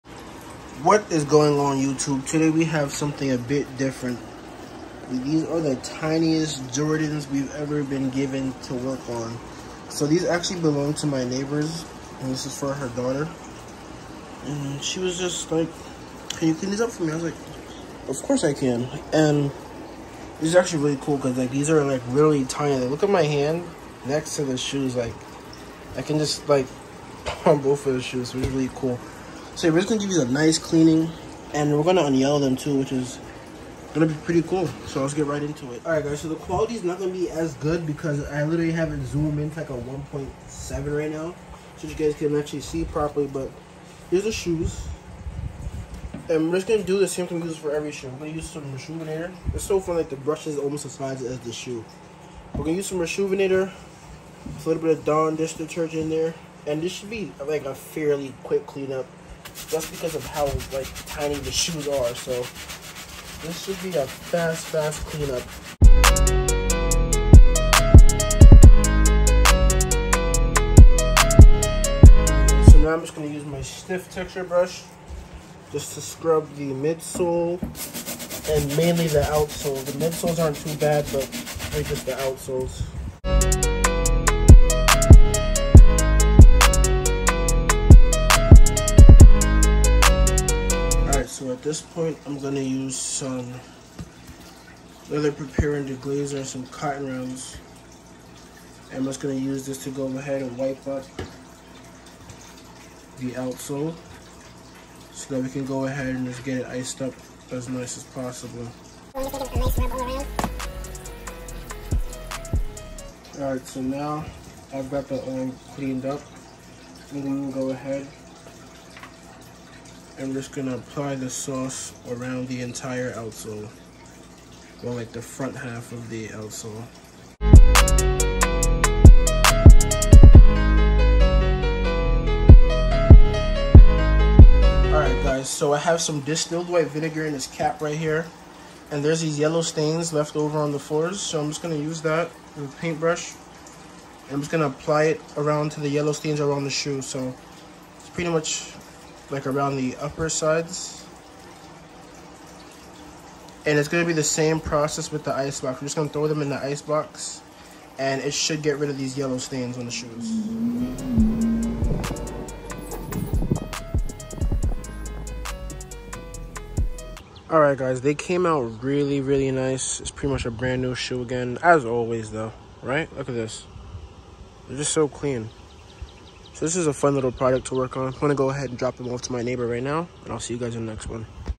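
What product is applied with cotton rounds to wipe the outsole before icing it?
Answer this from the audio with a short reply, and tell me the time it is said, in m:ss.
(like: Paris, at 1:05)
leather preparing deglazer, at 1:35.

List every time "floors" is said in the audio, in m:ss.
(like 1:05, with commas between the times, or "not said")
2:20.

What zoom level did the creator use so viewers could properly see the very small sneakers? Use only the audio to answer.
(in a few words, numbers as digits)
1.7.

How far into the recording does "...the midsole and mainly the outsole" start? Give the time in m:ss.
1:16.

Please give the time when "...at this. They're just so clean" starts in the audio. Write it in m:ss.
2:53.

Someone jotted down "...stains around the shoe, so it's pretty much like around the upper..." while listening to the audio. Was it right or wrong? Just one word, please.
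right.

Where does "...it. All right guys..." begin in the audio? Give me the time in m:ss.
0:35.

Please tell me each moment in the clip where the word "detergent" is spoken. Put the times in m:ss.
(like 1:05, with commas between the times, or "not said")
0:55.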